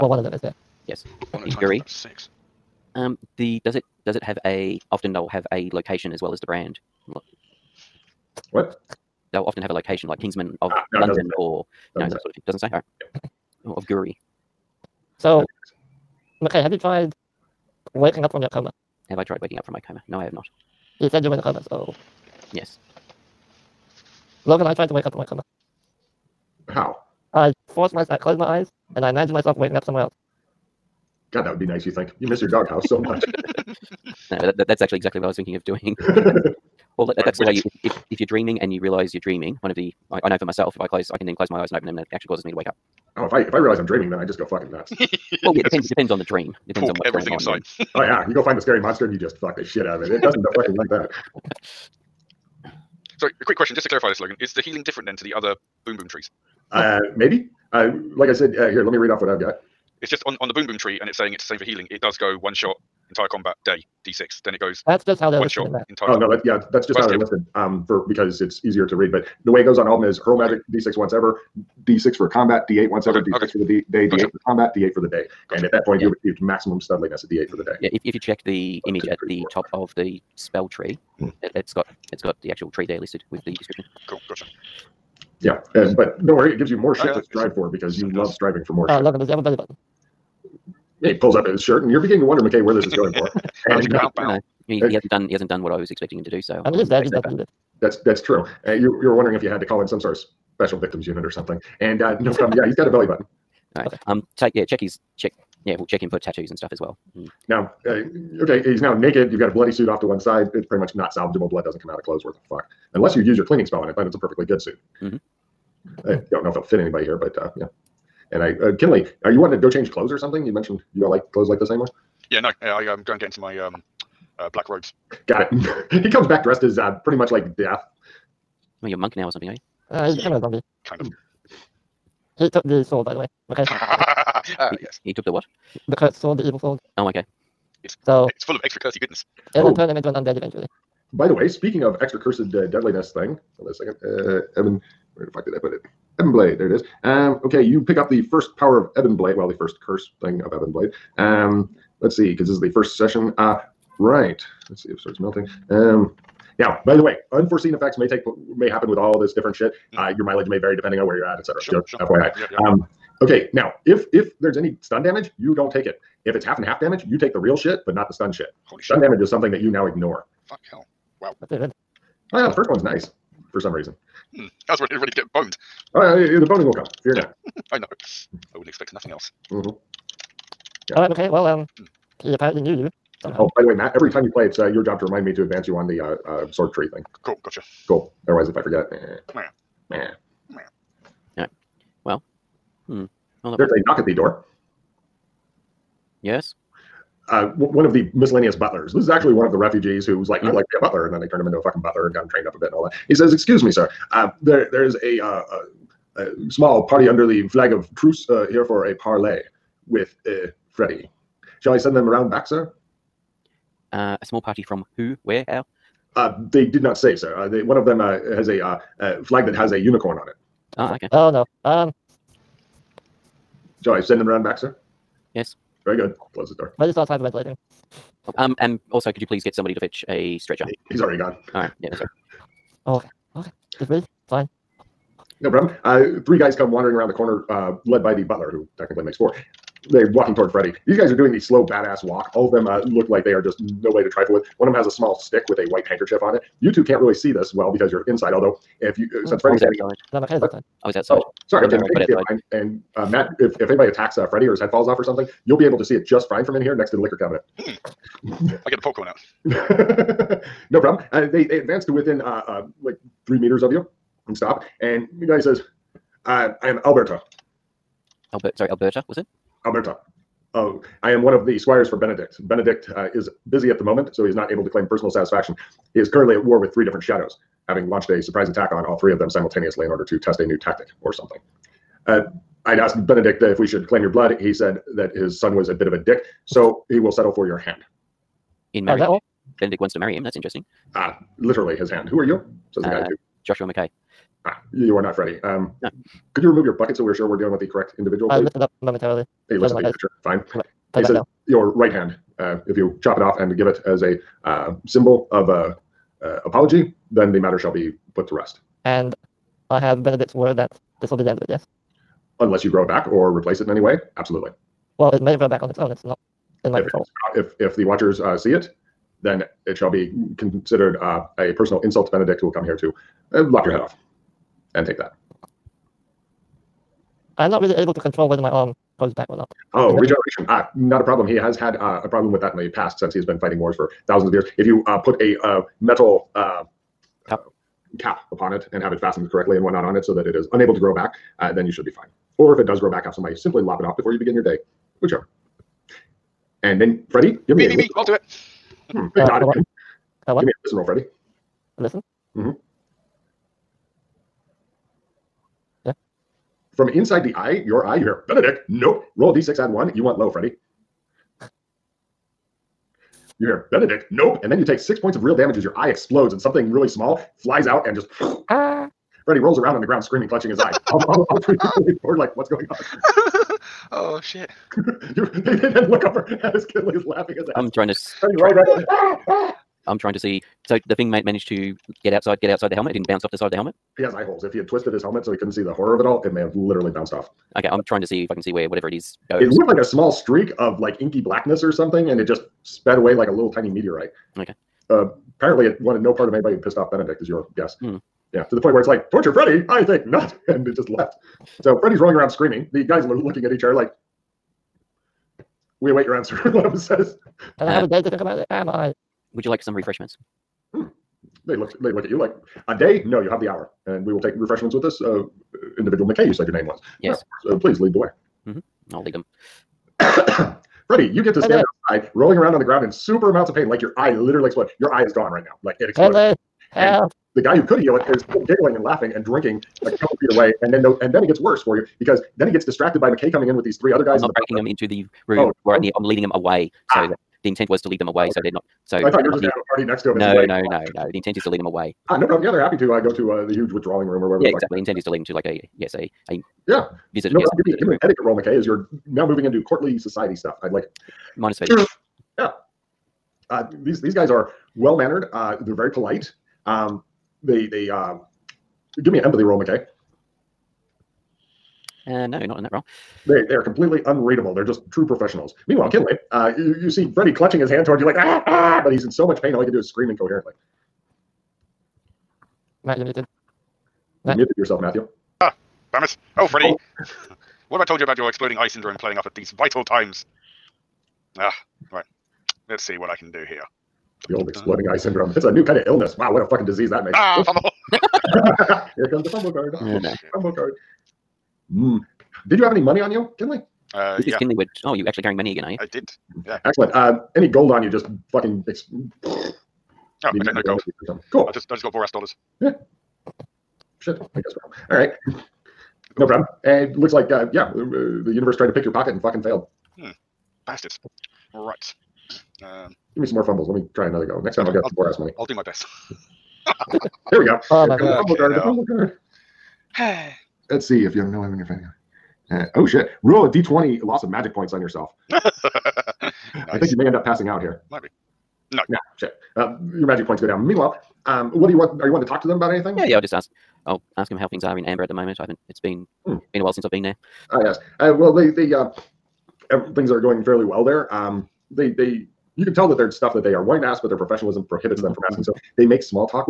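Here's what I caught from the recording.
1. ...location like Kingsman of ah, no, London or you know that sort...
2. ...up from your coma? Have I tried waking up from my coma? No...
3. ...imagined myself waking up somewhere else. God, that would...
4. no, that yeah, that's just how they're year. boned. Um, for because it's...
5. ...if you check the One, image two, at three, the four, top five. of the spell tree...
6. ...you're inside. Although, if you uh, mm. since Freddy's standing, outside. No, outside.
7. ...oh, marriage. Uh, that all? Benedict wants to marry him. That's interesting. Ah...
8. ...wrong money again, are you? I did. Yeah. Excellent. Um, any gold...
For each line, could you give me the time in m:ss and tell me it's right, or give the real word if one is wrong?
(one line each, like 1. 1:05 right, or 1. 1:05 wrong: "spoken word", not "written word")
1. 0:09 right
2. 0:18 right
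3. 0:29 right
4. 1:06 wrong: "listed", not "boned"
5. 1:18 right
6. 4:07 right
7. 4:48 right
8. 8:15 wrong: "carrying", not "wrong".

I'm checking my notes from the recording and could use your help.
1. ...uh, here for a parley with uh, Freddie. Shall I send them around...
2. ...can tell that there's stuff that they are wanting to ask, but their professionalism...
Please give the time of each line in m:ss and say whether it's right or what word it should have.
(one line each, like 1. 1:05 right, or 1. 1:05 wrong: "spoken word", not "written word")
1. 3:28 right
2. 9:02 right.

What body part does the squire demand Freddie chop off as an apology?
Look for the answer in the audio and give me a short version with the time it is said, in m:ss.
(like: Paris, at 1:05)
right hand, at 5:01.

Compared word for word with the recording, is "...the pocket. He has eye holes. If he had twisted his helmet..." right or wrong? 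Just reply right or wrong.
wrong.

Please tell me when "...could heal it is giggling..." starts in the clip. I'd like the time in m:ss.
7:07.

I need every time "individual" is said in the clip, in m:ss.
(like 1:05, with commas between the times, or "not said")
4:57, 6:55.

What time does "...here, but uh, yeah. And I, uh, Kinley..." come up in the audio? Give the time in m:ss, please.
1:57.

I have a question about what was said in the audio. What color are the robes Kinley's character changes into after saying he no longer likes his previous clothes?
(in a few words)
black.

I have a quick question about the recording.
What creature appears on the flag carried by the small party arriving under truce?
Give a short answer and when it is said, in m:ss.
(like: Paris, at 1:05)
unicorn, at 3:39.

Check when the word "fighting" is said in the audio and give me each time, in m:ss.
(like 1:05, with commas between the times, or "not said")
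5:33, 8:41.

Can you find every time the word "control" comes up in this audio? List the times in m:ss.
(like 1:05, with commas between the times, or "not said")
5:16, 5:27.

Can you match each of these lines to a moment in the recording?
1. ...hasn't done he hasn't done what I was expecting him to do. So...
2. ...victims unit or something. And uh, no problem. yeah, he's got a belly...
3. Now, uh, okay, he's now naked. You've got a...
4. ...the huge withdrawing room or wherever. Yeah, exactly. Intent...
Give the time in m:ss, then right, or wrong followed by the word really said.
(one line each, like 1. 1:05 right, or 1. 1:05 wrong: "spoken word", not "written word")
1. 1:34 right
2. 1:40 right
3. 1:47 right
4. 7:23 right.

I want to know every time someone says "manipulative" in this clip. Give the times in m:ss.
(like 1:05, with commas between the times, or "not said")
not said.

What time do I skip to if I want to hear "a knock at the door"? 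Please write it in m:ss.
3:13.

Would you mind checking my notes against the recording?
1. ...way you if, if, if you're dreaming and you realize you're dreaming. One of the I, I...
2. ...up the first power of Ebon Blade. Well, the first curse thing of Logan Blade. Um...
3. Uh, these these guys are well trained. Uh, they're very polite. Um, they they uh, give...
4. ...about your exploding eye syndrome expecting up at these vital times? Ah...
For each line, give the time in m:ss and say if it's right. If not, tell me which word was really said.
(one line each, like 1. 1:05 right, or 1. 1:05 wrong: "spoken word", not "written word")
1. 0:37 right
2. 2:27 wrong: "Ebon", not "Logan"
3. 7:33 wrong: "mannered", not "trained"
4. 7:58 wrong: "playing", not "expecting".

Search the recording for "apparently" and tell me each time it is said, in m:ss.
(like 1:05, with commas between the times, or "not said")
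3:02, 6:35.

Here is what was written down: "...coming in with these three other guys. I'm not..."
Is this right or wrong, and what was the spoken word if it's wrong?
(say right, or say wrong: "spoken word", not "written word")
right.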